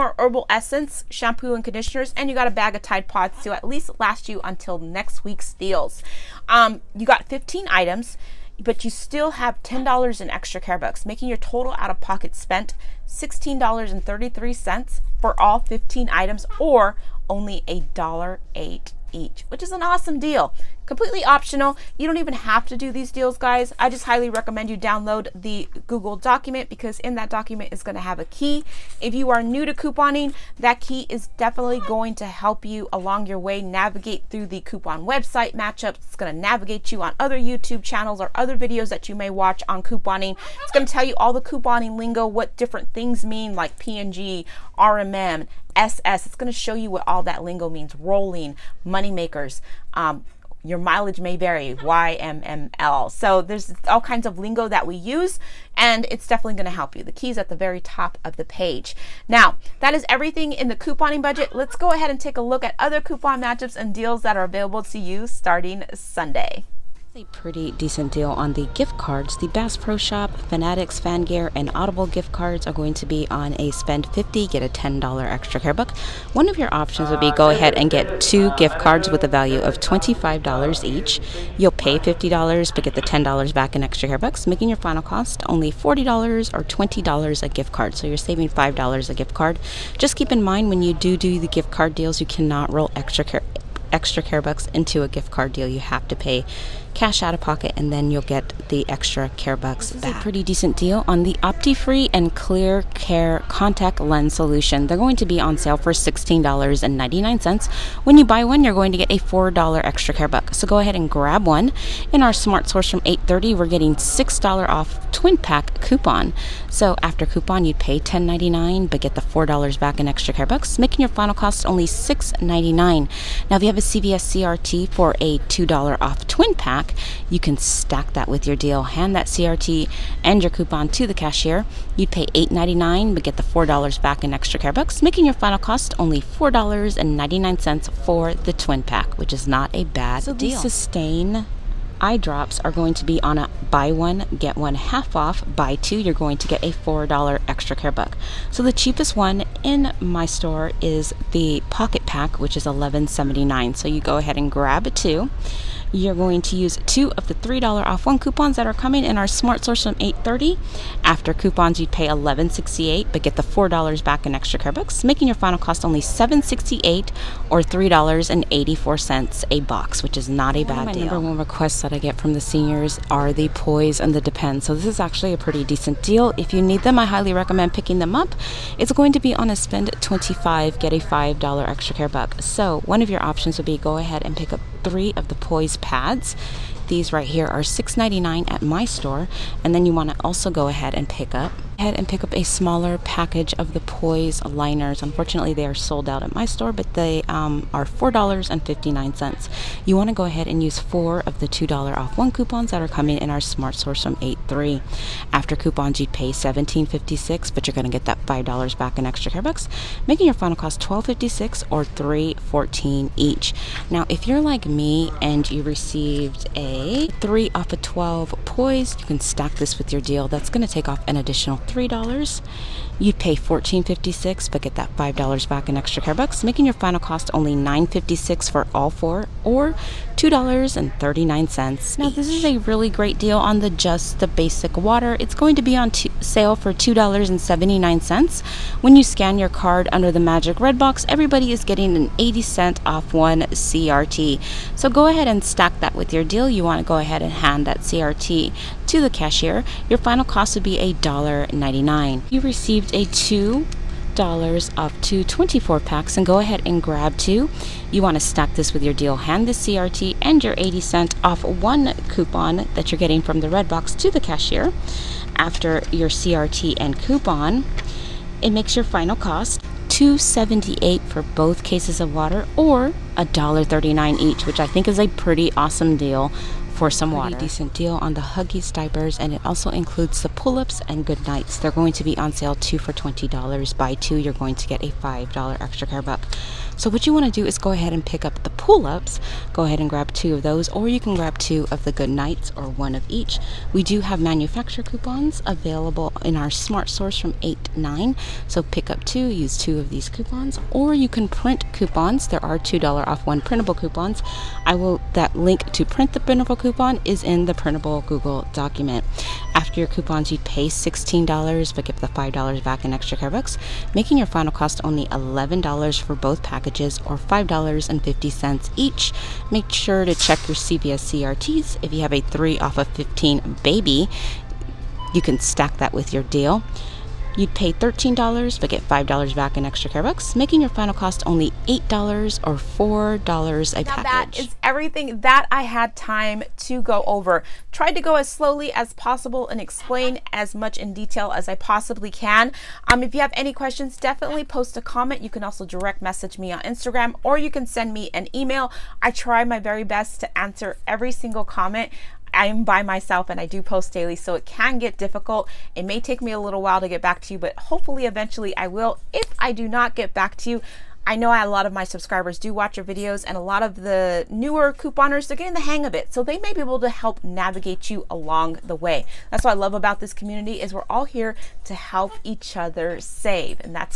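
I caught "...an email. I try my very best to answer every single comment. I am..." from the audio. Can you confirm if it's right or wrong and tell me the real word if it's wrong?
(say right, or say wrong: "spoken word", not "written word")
right.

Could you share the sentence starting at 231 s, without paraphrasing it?
Now this is a really great deal on the just the basic water.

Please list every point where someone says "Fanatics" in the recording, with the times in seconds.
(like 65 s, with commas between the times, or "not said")
70 s.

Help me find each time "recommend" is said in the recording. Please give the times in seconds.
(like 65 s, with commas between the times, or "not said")
24 s, 177 s.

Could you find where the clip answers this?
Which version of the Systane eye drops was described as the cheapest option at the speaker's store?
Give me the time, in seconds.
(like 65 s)
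151 s.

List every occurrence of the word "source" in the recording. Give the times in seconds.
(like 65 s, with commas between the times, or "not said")
112 s, 159 s, 203 s, 296 s.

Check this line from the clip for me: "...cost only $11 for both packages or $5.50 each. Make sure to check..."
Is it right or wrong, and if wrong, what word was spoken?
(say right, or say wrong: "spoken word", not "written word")
right.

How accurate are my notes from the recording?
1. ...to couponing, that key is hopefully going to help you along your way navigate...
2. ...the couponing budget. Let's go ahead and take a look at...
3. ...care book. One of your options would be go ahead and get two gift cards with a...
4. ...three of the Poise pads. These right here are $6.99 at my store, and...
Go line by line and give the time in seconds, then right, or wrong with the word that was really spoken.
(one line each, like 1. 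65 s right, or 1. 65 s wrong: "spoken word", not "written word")
1. 29 s wrong: "definitely", not "hopefully"
2. 60 s right
3. 75 s right
4. 184 s right.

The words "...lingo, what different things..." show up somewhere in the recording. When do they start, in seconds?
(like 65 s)
41 s.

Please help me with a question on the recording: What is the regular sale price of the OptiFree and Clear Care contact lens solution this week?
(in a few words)
$16.99.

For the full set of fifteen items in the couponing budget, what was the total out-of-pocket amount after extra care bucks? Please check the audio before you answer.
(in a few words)
$16.33.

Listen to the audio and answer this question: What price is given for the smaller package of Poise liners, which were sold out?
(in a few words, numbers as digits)
$4.59.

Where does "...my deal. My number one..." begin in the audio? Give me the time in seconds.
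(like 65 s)
170 s.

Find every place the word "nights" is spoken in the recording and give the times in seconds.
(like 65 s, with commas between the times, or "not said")
281 s, 292 s.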